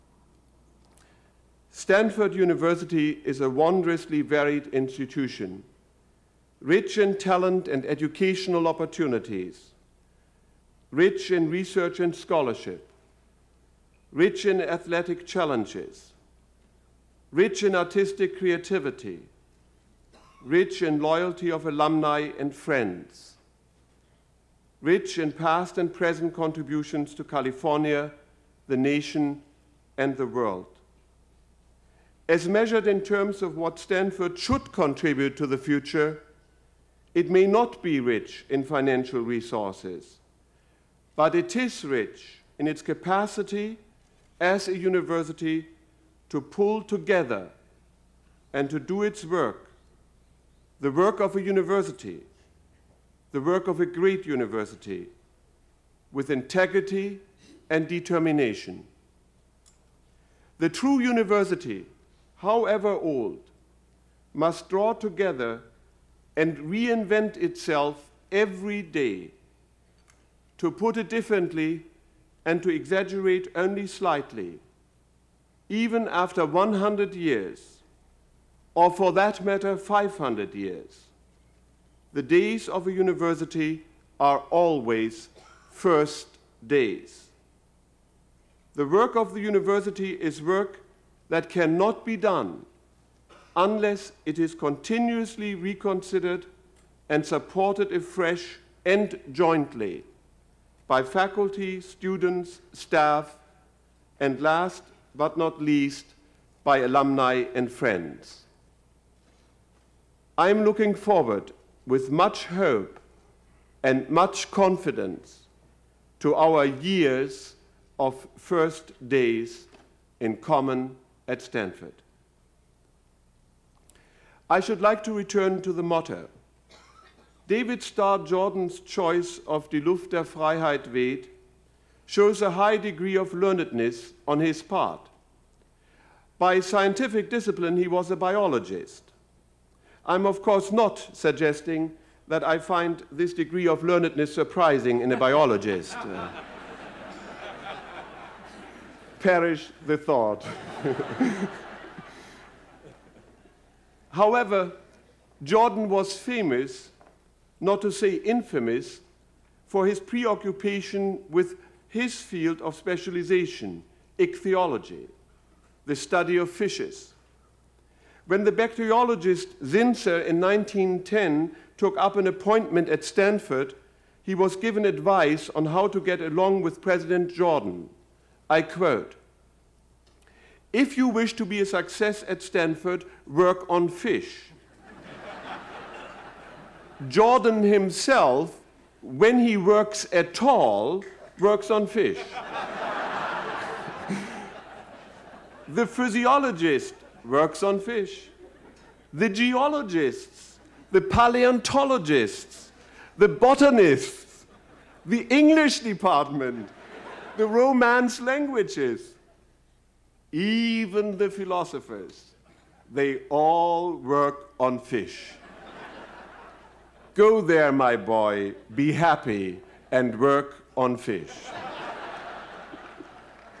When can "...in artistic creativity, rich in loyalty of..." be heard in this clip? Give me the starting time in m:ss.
0:17.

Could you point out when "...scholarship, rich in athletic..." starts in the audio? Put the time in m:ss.
0:12.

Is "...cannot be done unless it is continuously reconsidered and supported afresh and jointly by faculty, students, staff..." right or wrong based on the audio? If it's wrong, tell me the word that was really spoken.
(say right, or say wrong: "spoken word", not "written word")
right.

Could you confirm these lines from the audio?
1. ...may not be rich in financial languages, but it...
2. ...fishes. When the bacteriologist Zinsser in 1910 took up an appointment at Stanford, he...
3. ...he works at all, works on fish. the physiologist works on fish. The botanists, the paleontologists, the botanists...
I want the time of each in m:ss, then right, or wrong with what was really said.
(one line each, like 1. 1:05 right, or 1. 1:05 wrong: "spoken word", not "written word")
1. 0:37 wrong: "resources", not "languages"
2. 2:46 right
3. 3:09 wrong: "geologists", not "botanists".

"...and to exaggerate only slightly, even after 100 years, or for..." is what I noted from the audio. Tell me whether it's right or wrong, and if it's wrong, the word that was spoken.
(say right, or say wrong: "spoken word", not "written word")
right.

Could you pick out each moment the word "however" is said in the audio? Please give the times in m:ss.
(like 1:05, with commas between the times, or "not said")
1:02, 2:34.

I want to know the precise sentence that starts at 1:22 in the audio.
The days of a university are always first days.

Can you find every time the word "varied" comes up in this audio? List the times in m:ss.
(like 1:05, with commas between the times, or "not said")
0:04.